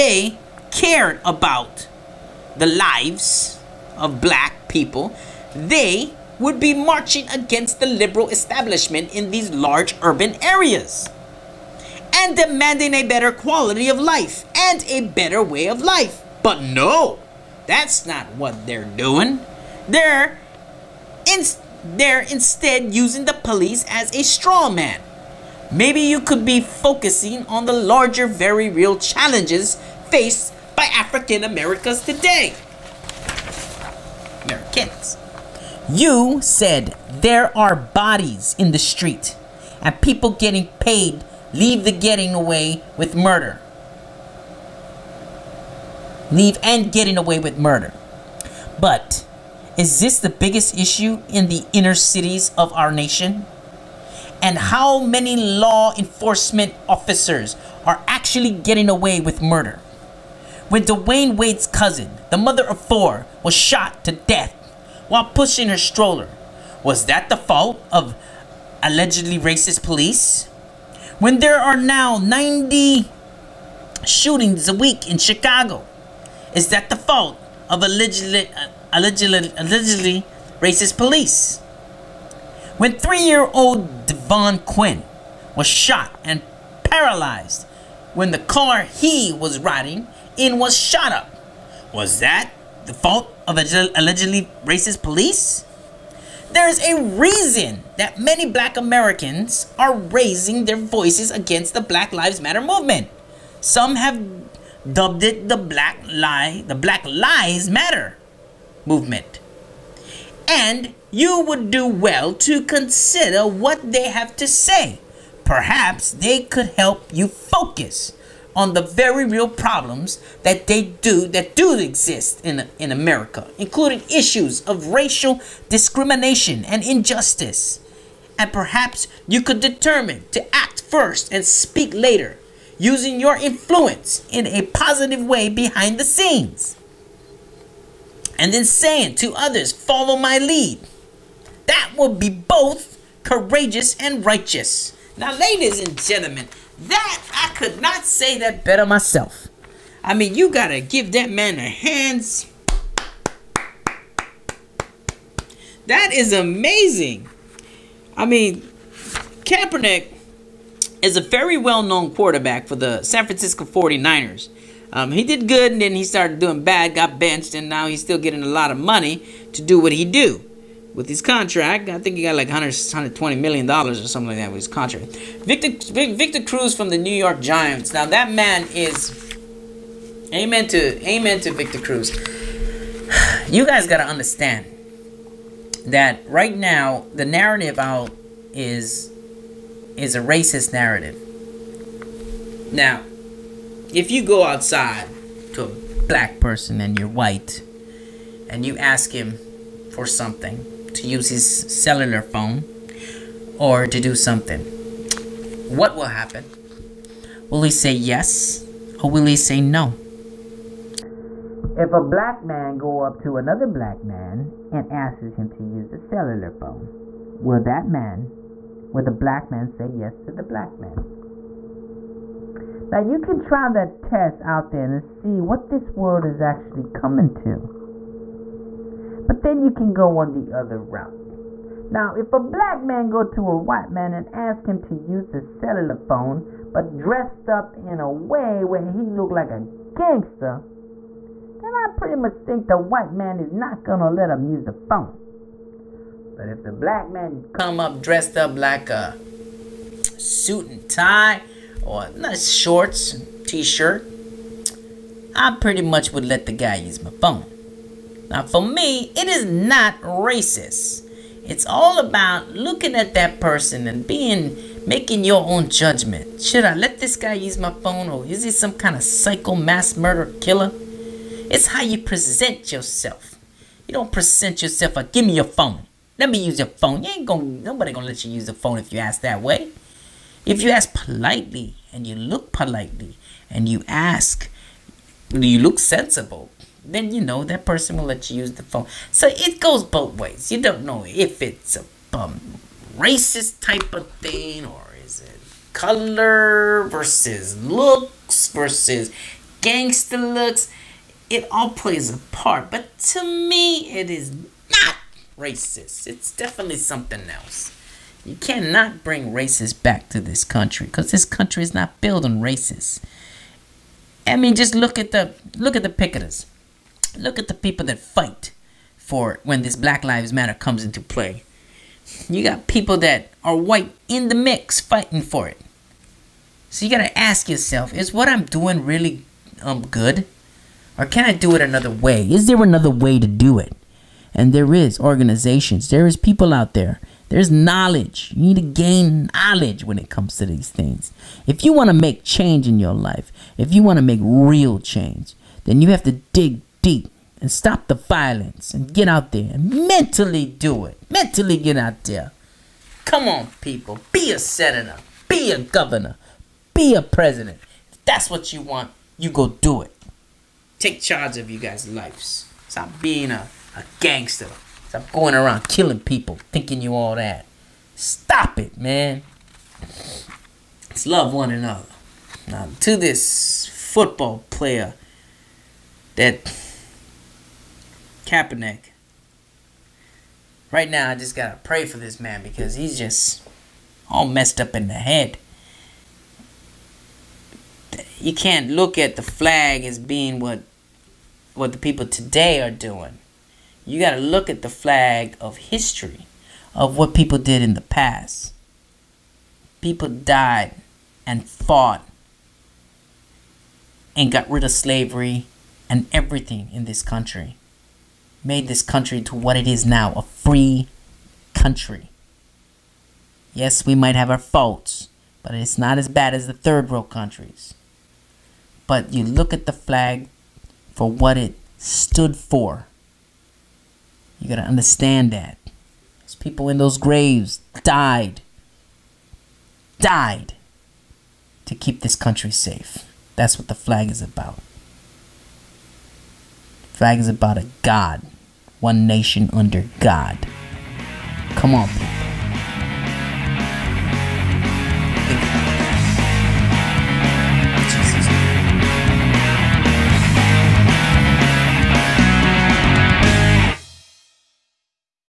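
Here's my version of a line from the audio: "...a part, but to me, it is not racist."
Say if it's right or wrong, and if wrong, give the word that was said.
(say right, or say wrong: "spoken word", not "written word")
right.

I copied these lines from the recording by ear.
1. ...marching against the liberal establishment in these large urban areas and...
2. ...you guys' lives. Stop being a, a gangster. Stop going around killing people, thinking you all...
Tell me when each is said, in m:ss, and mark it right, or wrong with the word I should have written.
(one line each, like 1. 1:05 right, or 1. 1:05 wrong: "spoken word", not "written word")
1. 0:06 right
2. 6:01 right.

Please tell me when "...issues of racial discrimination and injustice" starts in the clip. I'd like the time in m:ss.
2:04.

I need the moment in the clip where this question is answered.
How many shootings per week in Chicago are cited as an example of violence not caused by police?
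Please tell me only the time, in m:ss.
1:12.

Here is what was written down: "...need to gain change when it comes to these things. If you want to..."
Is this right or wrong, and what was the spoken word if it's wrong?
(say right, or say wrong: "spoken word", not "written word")
wrong: "knowledge", not "change".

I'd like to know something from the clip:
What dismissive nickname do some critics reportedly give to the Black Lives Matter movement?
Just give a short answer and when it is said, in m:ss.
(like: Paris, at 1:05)
the Black Lie, at 1:45.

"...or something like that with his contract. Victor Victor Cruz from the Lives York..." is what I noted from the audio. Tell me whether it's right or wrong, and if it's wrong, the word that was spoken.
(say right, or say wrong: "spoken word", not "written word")
wrong: "New", not "Lives".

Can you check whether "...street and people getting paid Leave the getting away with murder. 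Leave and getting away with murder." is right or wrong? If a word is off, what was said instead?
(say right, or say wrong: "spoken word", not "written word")
right.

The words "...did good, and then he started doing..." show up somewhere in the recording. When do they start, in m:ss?
2:45.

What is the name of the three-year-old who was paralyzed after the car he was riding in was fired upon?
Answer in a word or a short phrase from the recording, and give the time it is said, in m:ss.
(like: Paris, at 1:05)
Devon Quinn, at 1:24.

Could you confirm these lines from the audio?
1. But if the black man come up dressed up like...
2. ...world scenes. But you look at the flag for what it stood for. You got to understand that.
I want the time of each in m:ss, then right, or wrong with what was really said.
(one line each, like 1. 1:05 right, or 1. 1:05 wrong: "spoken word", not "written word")
1. 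4:06 right
2. 6:56 wrong: "countries", not "scenes".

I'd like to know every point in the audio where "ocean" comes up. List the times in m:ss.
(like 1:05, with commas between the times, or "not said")
not said.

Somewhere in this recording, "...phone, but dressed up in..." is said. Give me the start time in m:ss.
3:55.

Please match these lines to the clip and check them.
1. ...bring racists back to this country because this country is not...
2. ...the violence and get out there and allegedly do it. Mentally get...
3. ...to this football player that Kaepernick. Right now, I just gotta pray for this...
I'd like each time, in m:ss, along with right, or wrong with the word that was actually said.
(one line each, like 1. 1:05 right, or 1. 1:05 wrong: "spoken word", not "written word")
1. 5:09 right
2. 5:47 wrong: "mentally", not "allegedly"
3. 6:12 right.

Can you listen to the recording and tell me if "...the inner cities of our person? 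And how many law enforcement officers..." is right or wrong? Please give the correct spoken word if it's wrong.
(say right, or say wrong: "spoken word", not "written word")
wrong: "nation", not "person".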